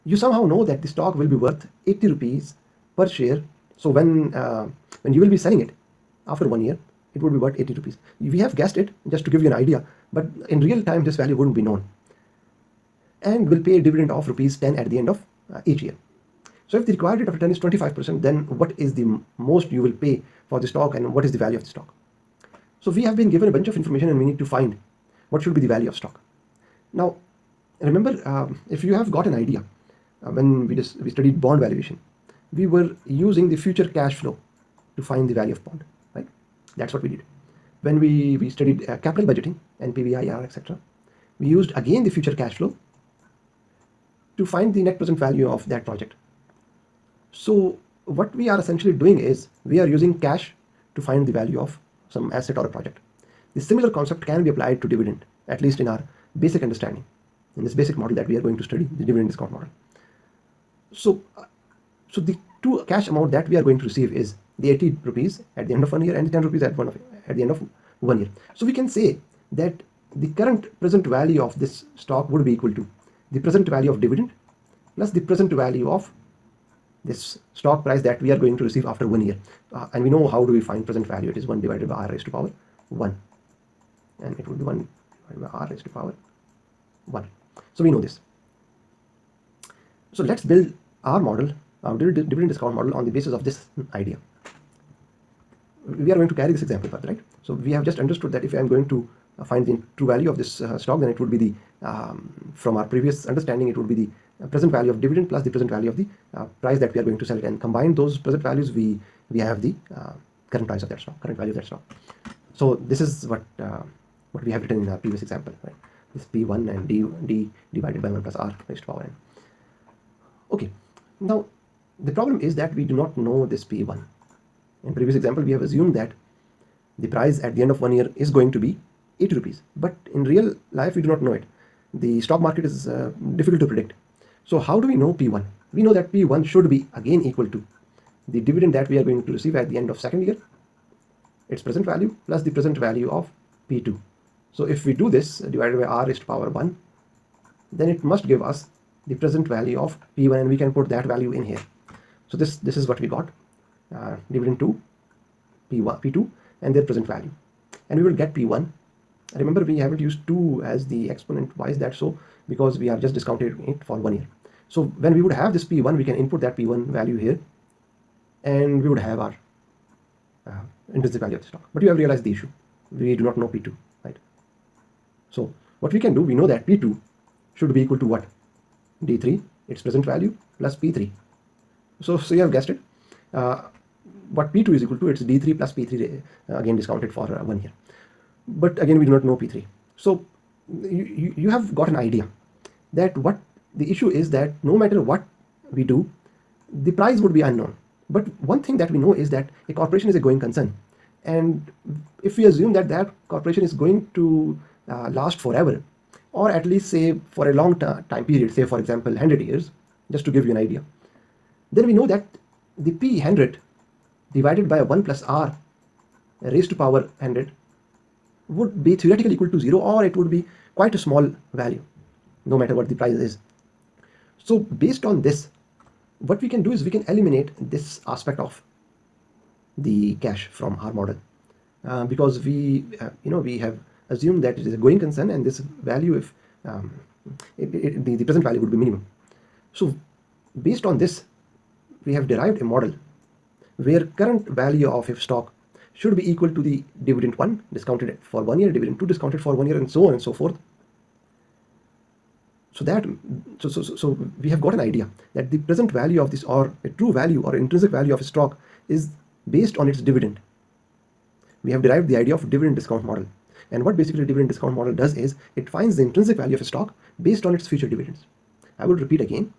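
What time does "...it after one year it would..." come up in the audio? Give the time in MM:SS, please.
00:05.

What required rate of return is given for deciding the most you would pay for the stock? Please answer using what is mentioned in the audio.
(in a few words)
25%.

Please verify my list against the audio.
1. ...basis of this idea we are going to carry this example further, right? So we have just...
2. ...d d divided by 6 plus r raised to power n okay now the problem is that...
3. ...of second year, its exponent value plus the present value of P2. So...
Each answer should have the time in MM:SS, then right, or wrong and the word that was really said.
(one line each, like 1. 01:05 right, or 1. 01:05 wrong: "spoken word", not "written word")
1. 01:33 right
2. 01:56 wrong: "1", not "6"
3. 02:19 wrong: "present", not "exponent".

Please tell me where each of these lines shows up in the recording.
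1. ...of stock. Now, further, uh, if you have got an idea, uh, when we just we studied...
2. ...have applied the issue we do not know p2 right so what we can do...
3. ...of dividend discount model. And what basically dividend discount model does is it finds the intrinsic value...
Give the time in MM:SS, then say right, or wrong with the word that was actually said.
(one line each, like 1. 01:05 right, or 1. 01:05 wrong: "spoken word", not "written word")
1. 00:25 wrong: "remember", not "further"
2. 02:51 wrong: "realized", not "applied"
3. 04:22 right.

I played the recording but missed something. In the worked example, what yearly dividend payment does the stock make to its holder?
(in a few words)
10 rupees.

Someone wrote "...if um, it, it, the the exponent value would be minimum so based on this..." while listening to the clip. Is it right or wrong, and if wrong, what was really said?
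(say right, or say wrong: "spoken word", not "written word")
wrong: "present", not "exponent".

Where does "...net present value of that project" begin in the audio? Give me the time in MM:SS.
00:44.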